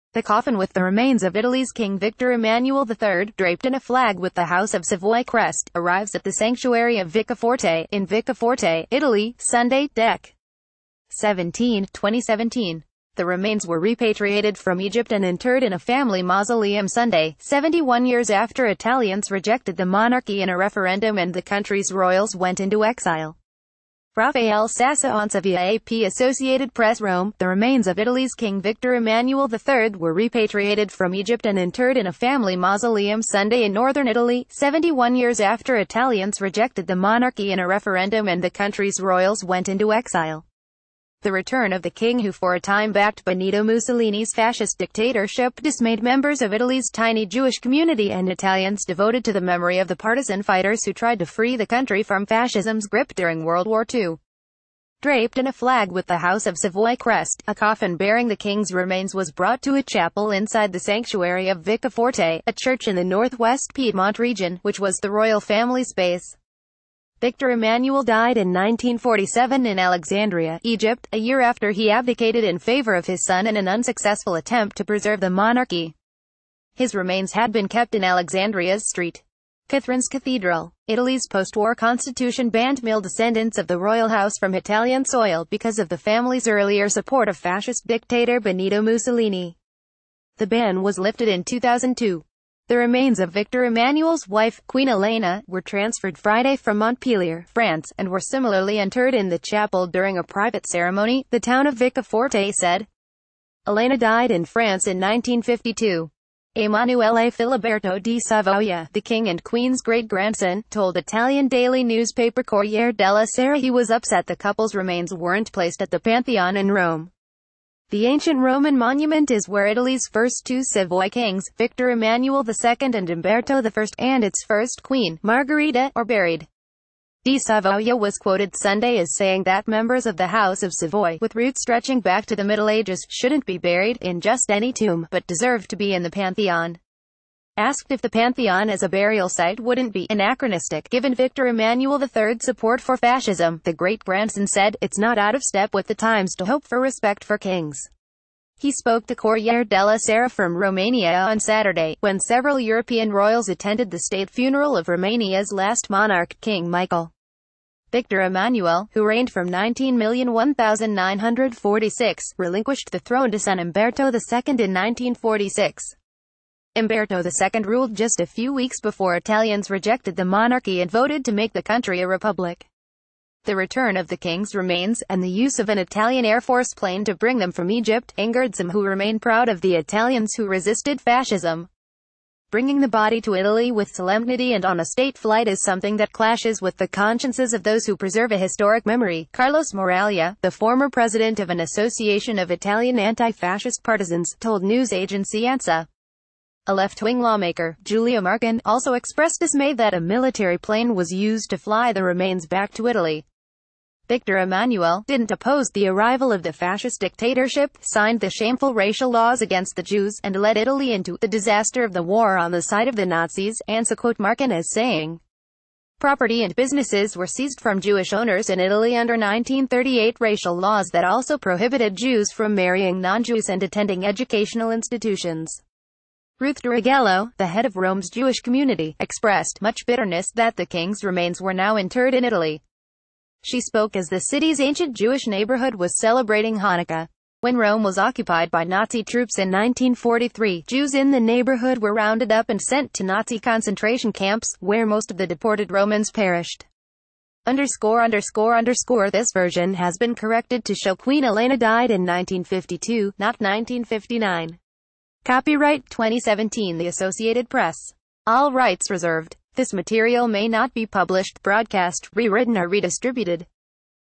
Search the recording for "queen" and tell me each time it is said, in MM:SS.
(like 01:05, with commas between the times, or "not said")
01:34, 01:49, 02:04, 04:10.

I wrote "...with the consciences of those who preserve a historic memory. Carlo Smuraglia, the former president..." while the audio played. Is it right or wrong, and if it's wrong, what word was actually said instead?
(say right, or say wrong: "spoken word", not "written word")
right.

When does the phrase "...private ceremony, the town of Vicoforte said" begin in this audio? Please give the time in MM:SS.
01:40.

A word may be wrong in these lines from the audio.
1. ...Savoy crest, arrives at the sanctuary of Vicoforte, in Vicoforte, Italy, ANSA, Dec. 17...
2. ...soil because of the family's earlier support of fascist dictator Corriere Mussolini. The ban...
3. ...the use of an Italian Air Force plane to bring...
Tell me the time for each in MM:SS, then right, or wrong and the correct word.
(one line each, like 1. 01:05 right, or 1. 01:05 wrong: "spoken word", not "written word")
1. 00:04 wrong: "Sunday", not "ANSA"
2. 01:25 wrong: "Benito", not "Corriere"
3. 02:55 right.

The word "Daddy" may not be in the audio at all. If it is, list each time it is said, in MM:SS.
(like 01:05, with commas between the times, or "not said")
not said.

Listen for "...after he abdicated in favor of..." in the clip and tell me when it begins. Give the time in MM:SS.
01:11.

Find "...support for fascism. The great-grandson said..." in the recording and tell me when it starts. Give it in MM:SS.
02:22.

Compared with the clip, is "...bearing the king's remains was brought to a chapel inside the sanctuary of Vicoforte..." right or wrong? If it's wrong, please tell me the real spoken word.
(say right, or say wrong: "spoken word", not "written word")
right.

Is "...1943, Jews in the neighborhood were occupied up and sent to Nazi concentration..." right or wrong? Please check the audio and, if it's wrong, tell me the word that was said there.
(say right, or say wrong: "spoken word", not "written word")
wrong: "rounded", not "occupied".